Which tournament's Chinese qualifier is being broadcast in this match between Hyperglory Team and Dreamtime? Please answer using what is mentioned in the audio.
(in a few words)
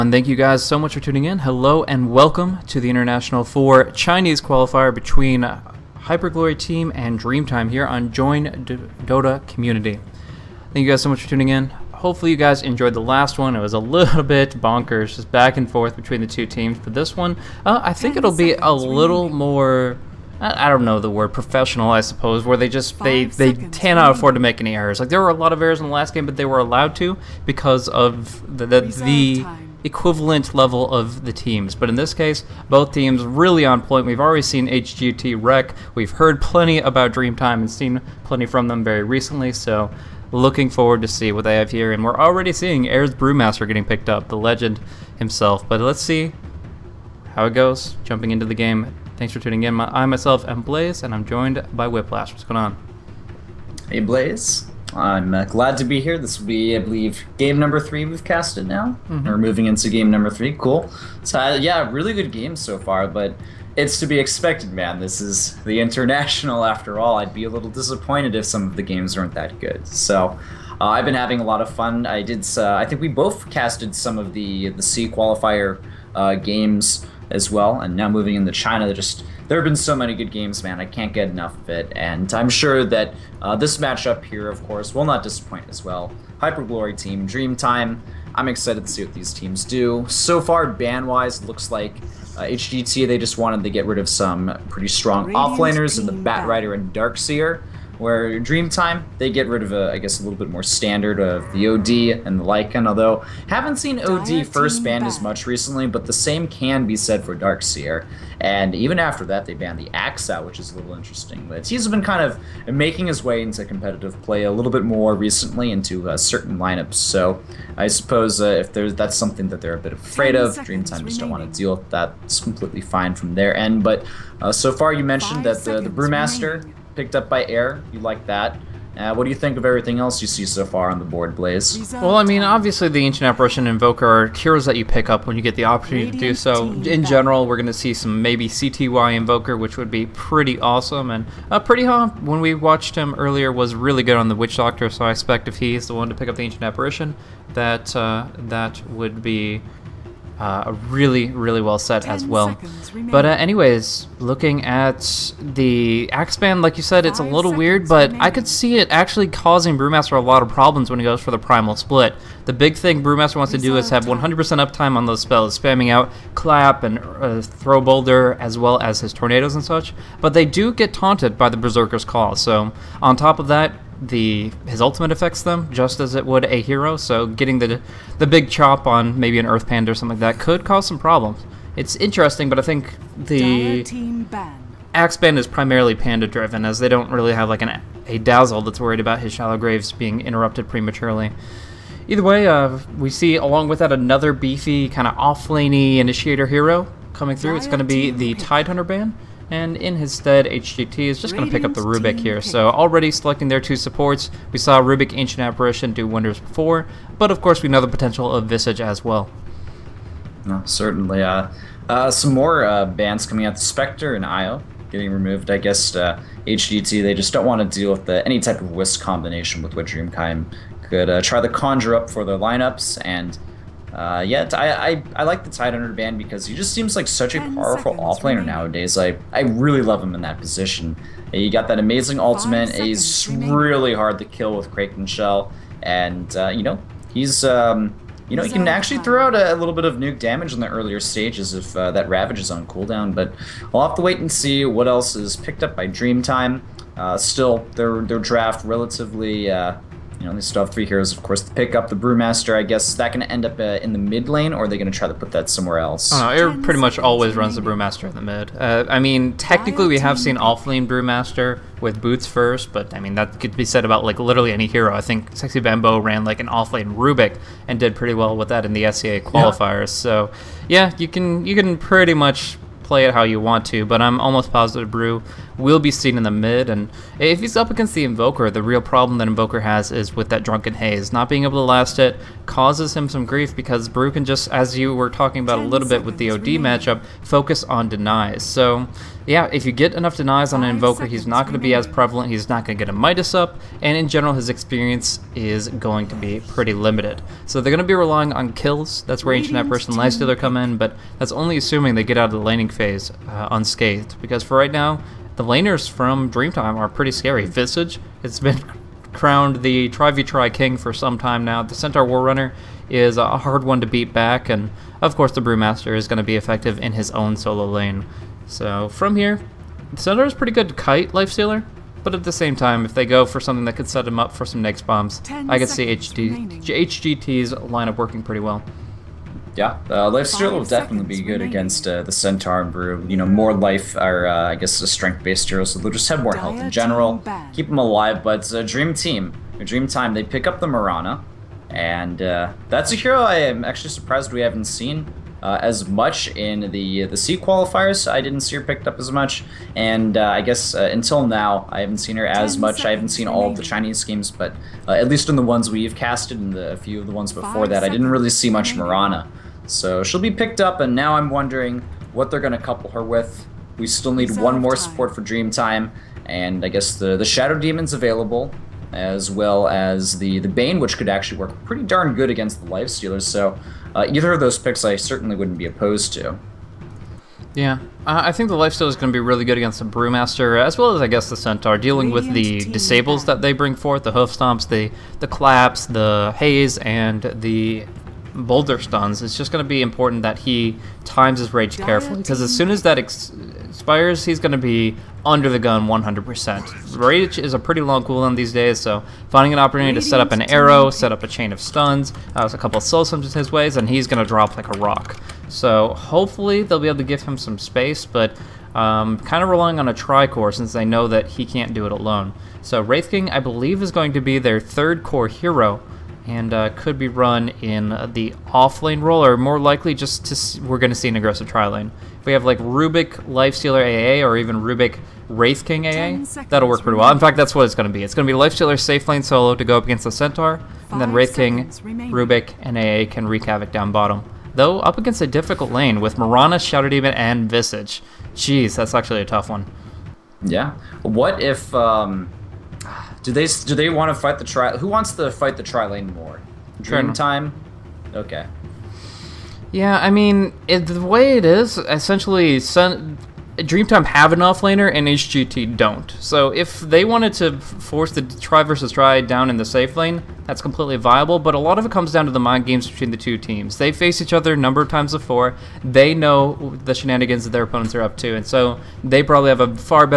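The International 4.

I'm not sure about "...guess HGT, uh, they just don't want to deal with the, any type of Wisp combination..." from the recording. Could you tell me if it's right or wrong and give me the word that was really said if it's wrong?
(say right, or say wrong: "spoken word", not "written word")
right.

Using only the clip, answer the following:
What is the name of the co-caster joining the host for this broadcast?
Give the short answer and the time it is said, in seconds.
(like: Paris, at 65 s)
Whiplash, at 51 s.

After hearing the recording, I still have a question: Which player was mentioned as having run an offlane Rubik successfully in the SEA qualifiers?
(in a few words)
SexyBamboe.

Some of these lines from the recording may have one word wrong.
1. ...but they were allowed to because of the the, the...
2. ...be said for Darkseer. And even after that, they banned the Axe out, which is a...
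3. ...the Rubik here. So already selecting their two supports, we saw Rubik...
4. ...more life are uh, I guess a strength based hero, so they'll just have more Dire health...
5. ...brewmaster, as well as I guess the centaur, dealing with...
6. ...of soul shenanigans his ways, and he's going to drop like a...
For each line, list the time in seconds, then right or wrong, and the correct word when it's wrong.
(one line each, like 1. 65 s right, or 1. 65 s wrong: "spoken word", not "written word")
1. 26 s right
2. 106 s right
3. 201 s right
4. 333 s right
5. 379 s right
6. 402 s wrong: "summons", not "shenanigans".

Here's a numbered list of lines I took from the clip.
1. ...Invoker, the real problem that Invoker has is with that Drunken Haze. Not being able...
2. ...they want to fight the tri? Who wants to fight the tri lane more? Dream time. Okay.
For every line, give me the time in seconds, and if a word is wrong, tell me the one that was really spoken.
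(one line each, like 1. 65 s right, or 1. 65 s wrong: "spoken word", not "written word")
1. 278 s right
2. 443 s right.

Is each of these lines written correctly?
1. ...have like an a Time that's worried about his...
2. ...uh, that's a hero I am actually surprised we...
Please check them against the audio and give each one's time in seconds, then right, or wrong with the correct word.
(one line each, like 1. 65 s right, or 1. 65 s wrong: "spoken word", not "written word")
1. 187 s wrong: "Dazzle", not "Time"
2. 342 s right.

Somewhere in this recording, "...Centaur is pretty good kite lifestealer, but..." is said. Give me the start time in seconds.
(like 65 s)
320 s.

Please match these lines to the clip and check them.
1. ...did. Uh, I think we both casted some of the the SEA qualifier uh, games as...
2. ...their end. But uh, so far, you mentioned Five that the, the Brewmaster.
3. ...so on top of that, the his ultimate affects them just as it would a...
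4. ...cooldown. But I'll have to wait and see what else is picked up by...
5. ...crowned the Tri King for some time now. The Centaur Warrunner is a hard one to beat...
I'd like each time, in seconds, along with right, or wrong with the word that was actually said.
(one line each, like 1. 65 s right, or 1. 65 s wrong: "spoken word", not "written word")
1. 72 s right
2. 123 s right
3. 172 s right
4. 242 s right
5. 309 s right.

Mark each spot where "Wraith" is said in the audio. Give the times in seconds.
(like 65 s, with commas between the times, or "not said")
412 s, 425 s, 431 s.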